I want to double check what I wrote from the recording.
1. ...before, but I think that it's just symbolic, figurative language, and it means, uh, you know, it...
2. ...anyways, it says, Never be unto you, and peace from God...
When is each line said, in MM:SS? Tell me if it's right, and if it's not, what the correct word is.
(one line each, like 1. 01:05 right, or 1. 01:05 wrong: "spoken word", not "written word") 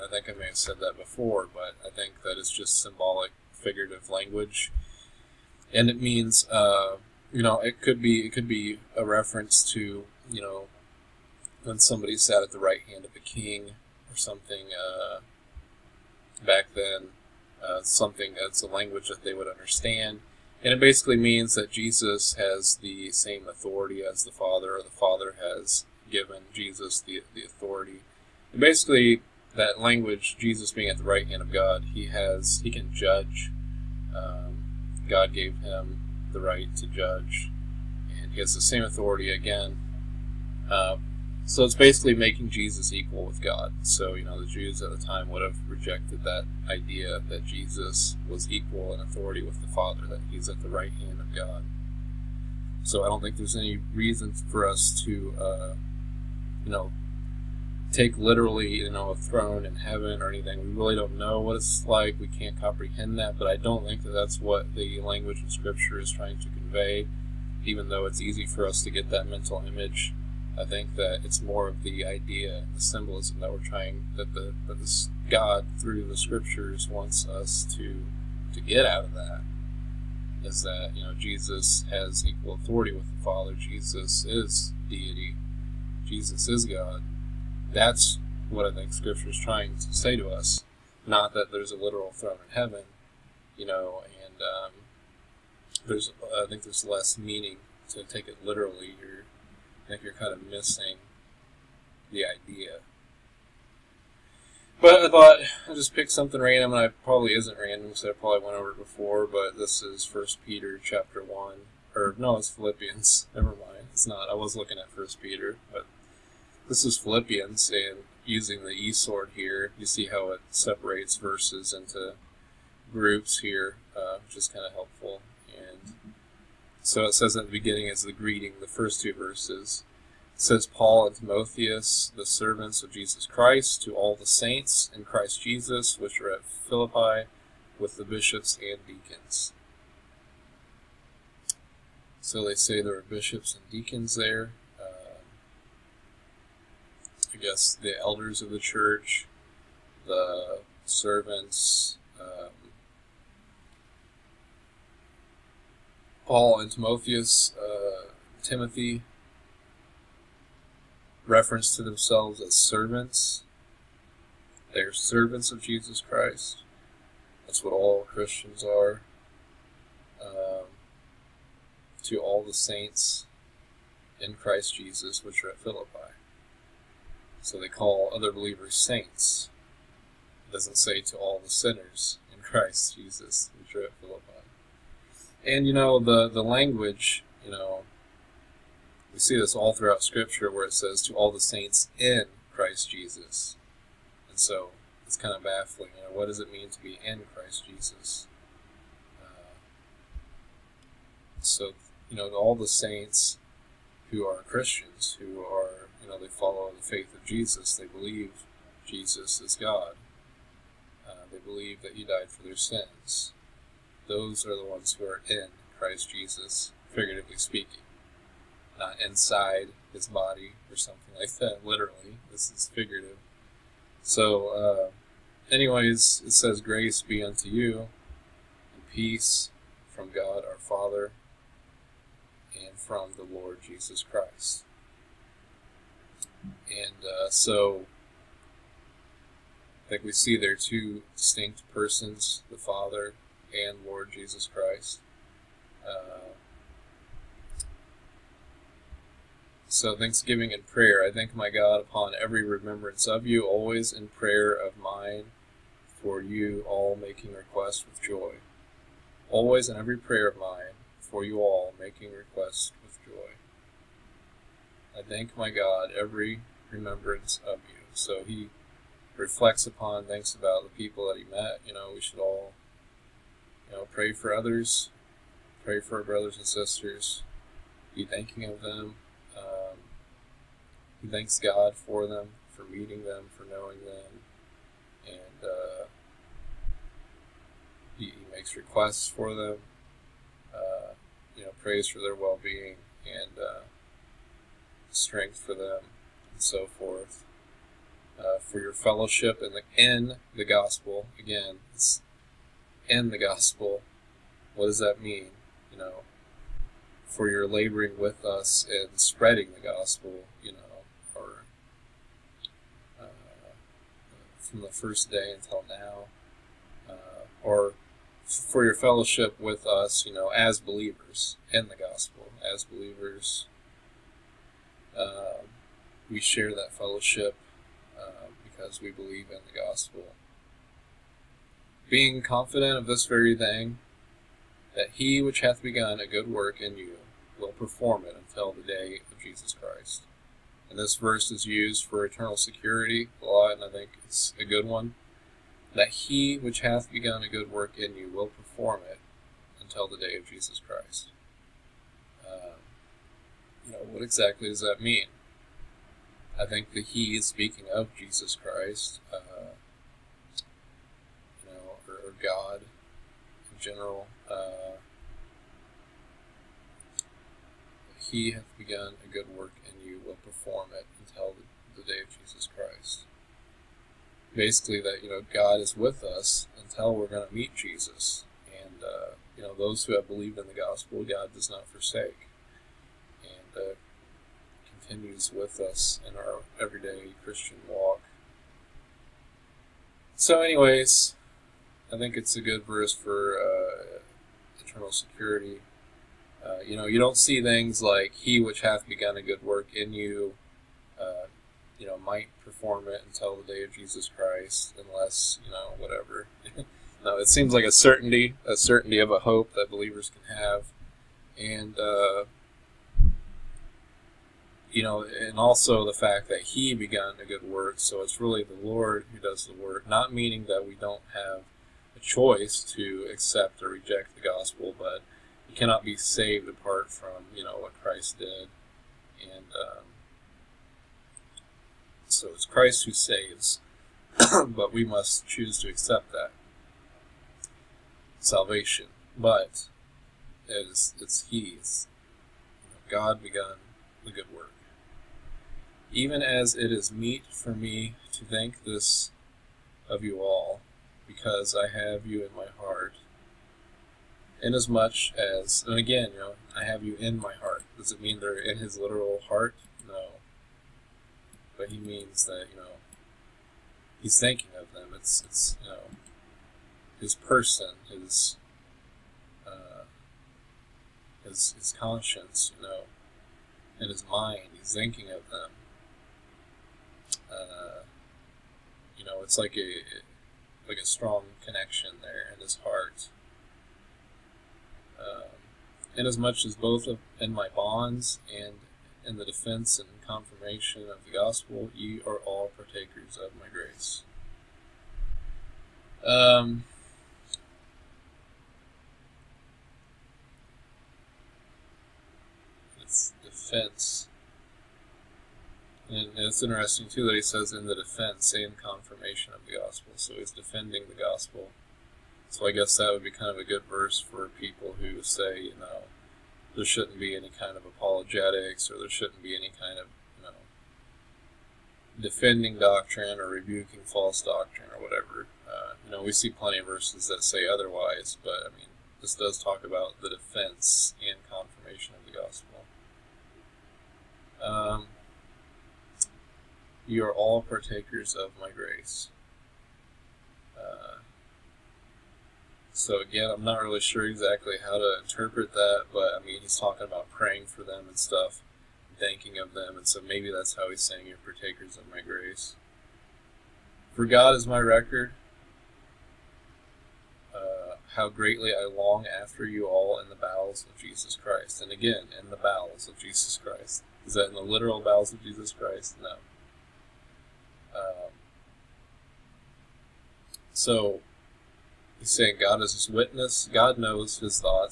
1. 00:00 right
2. 03:45 wrong: "Grace", not "Never".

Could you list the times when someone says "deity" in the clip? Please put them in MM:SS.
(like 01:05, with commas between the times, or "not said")
01:24.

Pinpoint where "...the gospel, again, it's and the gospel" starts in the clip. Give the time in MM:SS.
05:00.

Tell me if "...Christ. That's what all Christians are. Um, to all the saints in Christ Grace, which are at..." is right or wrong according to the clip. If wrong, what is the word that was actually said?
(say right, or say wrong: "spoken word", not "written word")
wrong: "Jesus", not "Grace".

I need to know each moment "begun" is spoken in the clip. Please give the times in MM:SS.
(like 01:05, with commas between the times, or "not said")
05:35, 05:46, 06:08, 06:38, 07:23.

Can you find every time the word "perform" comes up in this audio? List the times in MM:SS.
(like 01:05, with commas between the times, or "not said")
05:37, 05:48, 06:10, 06:42.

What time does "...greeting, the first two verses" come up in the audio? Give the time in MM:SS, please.
02:08.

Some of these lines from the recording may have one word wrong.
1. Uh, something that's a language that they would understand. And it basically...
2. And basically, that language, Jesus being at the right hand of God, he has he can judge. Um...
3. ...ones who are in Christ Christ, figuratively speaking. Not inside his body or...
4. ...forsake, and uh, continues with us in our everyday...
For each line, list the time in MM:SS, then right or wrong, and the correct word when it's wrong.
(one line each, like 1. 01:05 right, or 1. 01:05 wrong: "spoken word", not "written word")
1. 00:17 right
2. 00:28 right
3. 03:34 wrong: "Jesus", not "Christ"
4. 06:21 right.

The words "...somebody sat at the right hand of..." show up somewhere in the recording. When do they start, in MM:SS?
00:11.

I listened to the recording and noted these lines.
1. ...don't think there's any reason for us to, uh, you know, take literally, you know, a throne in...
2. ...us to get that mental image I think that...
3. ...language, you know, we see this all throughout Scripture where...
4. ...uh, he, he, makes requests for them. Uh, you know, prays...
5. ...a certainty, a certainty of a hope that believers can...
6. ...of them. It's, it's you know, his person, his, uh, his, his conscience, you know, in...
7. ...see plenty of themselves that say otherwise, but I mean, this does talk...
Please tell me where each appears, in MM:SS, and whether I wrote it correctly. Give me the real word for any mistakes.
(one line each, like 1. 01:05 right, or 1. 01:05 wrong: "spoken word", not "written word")
1. 00:53 right
2. 01:08 right
3. 03:06 right
4. 04:45 right
5. 06:47 right
6. 07:44 right
7. 08:46 wrong: "verses", not "themselves".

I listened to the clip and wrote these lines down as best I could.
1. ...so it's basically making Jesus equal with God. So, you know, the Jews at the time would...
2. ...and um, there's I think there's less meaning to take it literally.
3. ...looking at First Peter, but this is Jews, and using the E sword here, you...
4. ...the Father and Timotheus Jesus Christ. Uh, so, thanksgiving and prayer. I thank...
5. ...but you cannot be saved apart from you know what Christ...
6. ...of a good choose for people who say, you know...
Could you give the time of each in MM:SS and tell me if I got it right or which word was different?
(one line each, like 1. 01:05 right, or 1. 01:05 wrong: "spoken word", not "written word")
1. 00:41 right
2. 01:34 right
3. 01:54 wrong: "Philippians", not "Jews"
4. 04:02 wrong: "Lord", not "Timotheus"
5. 07:04 right
6. 08:33 wrong: "verse", not "choose".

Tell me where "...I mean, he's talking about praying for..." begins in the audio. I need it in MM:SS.
09:06.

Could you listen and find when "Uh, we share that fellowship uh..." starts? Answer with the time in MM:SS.
05:24.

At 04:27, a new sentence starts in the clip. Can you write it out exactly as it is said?
So he reflects upon, thinks about the people that he met.